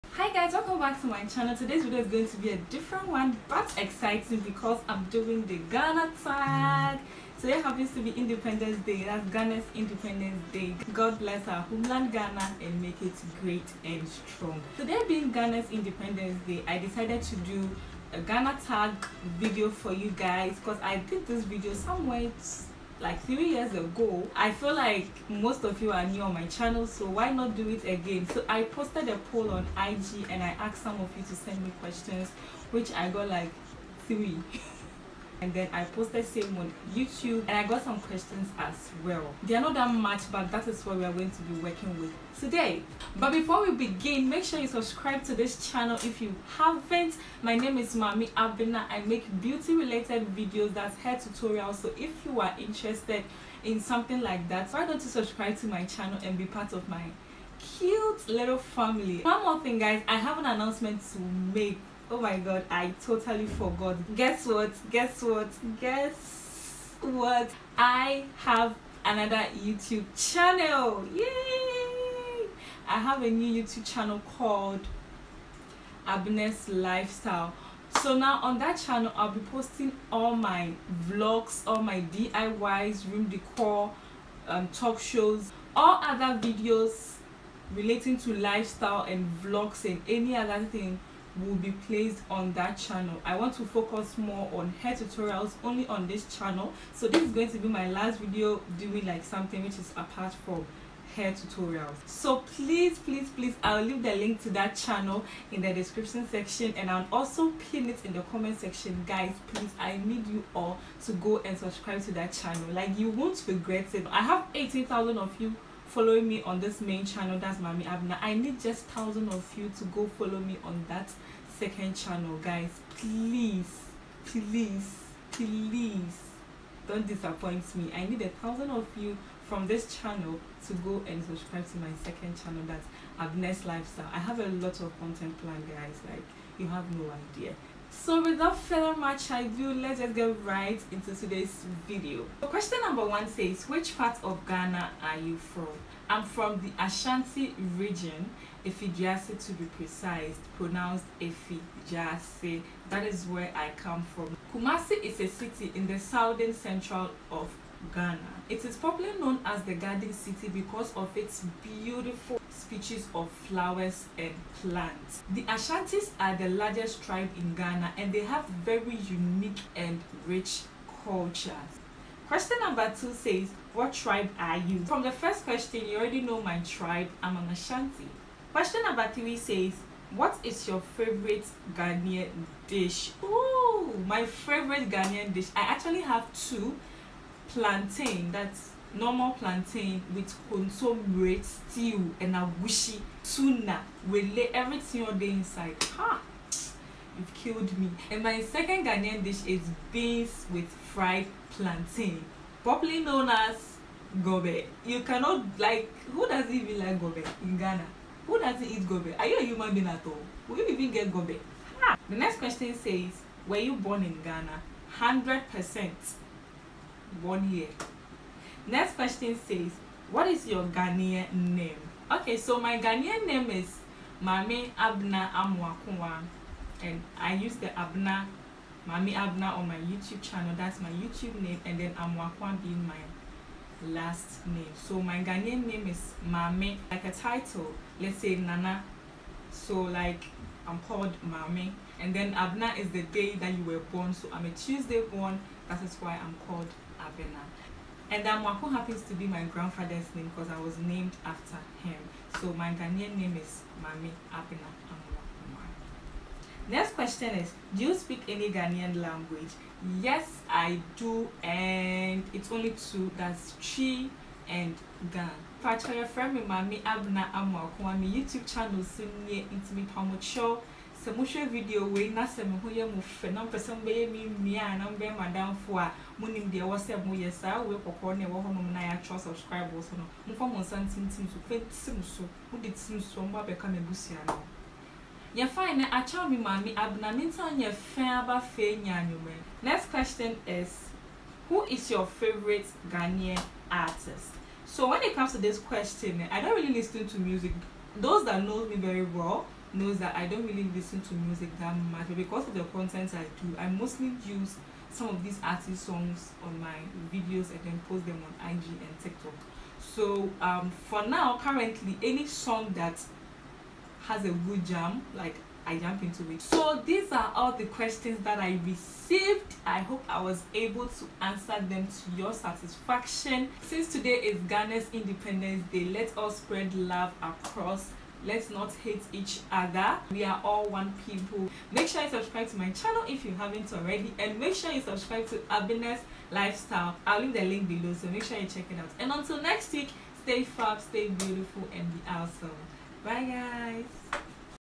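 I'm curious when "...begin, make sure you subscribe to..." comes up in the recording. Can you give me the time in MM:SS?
00:43.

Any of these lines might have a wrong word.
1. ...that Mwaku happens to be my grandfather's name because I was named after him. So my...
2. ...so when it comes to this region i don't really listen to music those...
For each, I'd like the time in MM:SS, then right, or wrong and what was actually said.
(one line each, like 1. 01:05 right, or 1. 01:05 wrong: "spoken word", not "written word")
1. 04:08 right
2. 04:54 wrong: "question", not "region".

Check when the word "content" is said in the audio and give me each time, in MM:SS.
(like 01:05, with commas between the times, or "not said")
02:14, 05:02.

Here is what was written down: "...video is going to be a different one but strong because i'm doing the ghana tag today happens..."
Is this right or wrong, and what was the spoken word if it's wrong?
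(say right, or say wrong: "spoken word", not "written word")
wrong: "exciting", not "strong".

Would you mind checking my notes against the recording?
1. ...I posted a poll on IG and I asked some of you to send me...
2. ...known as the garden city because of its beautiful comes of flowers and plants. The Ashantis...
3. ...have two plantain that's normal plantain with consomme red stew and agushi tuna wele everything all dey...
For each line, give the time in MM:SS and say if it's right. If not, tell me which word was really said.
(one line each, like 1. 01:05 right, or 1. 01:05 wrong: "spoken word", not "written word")
1. 00:28 right
2. 02:39 wrong: "species", not "comes"
3. 03:06 right.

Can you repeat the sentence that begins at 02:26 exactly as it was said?
I'm from the Ashanti region, Effiduase to be precise, pronounced Effiduase.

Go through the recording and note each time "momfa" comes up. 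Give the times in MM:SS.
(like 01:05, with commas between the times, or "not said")
04:40.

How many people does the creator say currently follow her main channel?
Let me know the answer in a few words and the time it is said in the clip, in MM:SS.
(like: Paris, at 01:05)
18,000, at 01:54.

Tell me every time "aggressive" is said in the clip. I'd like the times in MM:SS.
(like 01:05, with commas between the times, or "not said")
not said.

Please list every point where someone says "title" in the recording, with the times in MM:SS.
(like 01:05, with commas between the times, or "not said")
03:57.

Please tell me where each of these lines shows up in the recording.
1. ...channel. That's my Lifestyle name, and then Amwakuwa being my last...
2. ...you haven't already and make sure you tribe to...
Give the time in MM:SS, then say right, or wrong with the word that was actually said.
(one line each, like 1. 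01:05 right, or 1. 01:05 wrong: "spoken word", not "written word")
1. 03:50 wrong: "YouTube", not "Lifestyle"
2. 05:33 wrong: "subscribe", not "tribe".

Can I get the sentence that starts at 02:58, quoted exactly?
Question number three says, what is your favorite Ghanaian dish?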